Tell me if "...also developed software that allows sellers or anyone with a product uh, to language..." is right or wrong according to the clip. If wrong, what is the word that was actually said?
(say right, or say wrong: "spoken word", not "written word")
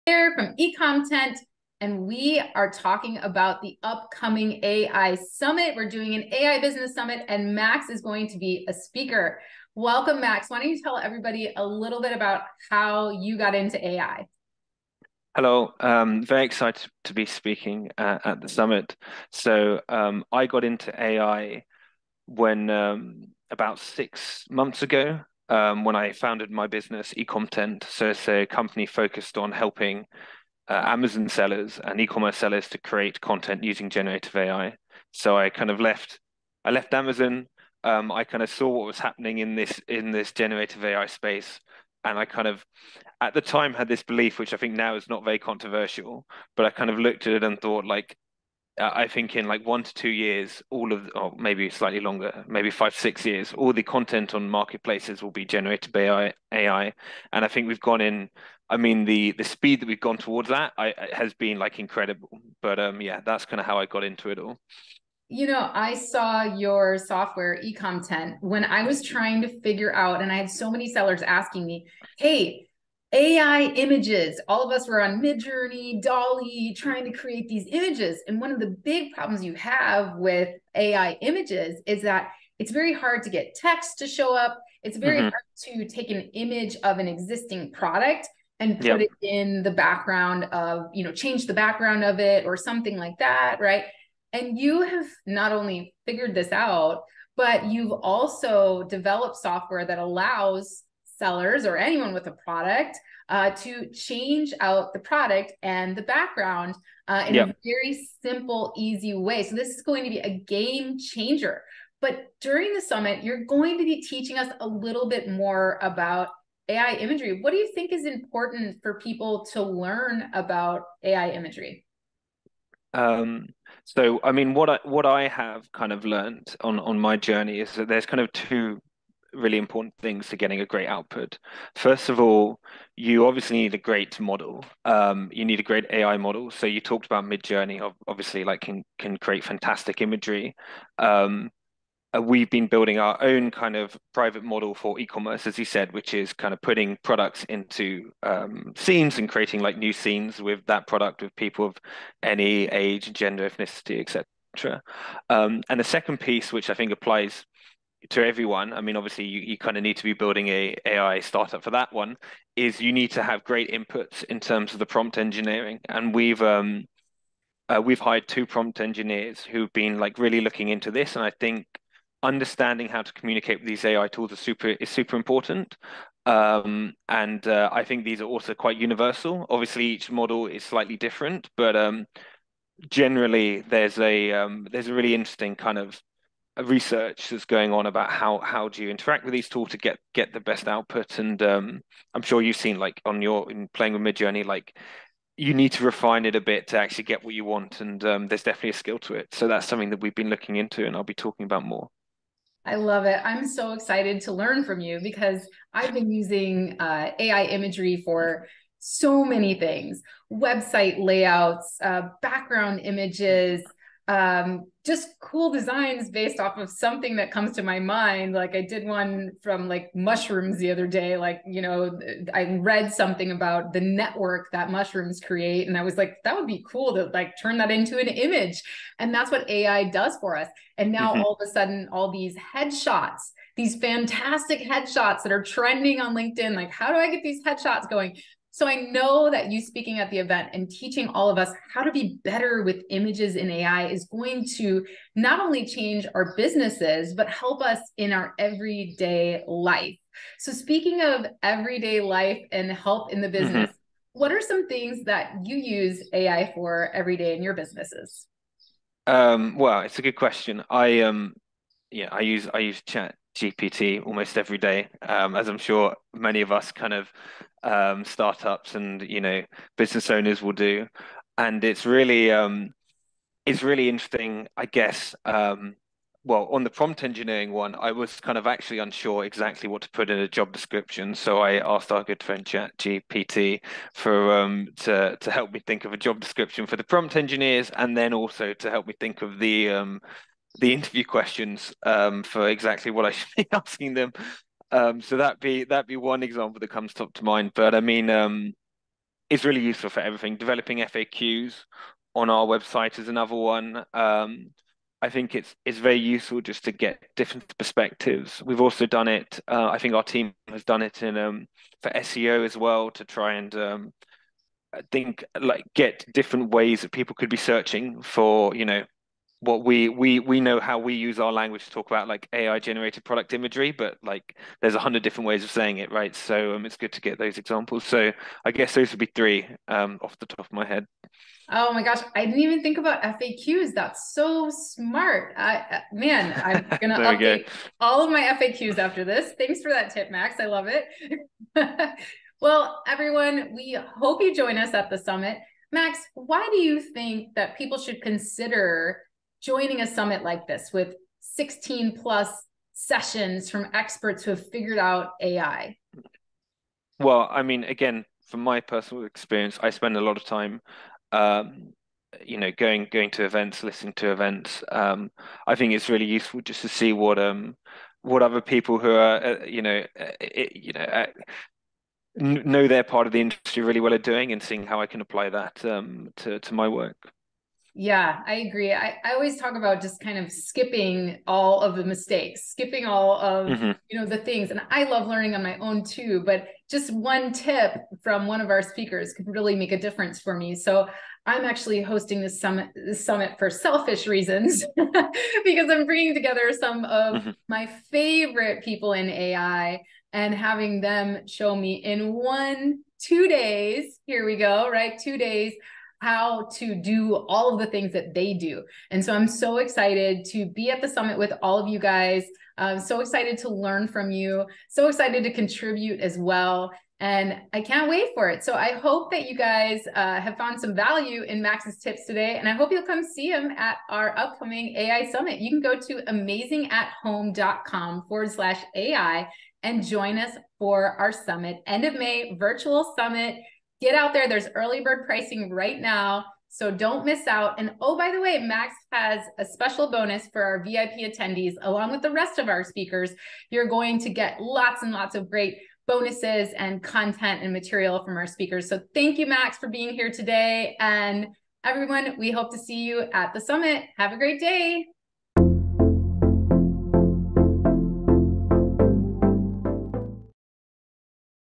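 wrong: "change", not "language".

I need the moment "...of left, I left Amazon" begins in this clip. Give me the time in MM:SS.
00:35.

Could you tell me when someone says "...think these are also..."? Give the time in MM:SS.
02:57.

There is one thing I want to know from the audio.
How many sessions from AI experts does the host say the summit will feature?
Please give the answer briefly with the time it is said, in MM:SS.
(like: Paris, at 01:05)
16+, at 05:51.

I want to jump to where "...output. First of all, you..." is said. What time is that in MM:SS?
02:10.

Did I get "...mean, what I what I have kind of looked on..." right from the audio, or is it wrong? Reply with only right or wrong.
wrong.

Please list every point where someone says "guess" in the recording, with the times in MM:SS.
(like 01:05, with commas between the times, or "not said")
04:34, 05:28.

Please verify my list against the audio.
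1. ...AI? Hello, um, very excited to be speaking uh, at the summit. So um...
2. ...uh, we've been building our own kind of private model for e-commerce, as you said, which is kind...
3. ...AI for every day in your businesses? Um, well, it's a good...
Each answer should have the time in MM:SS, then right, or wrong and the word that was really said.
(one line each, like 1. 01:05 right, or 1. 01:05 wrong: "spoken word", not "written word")
1. 00:13 right
2. 02:22 right
3. 04:16 right.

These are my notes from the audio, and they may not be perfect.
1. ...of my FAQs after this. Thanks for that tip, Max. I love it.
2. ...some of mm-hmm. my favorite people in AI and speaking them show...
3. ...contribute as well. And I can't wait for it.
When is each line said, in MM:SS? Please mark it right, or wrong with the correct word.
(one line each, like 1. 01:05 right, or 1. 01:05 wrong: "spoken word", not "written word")
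1. 05:38 right
2. 06:36 wrong: "having", not "speaking"
3. 06:55 right.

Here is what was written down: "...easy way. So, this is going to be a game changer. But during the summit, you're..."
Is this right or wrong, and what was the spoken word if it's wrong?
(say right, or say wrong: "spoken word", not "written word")
right.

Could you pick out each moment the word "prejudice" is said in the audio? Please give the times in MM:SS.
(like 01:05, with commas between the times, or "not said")
not said.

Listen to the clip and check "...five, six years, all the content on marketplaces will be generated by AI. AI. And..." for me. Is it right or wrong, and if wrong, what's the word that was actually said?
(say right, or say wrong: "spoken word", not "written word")
right.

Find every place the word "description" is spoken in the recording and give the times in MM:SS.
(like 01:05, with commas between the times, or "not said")
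04:40, 04:46.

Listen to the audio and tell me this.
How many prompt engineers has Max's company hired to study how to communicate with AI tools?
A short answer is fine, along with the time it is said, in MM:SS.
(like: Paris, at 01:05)
2, at 02:48.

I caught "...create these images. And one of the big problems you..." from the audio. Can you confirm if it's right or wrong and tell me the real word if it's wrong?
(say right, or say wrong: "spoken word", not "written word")
right.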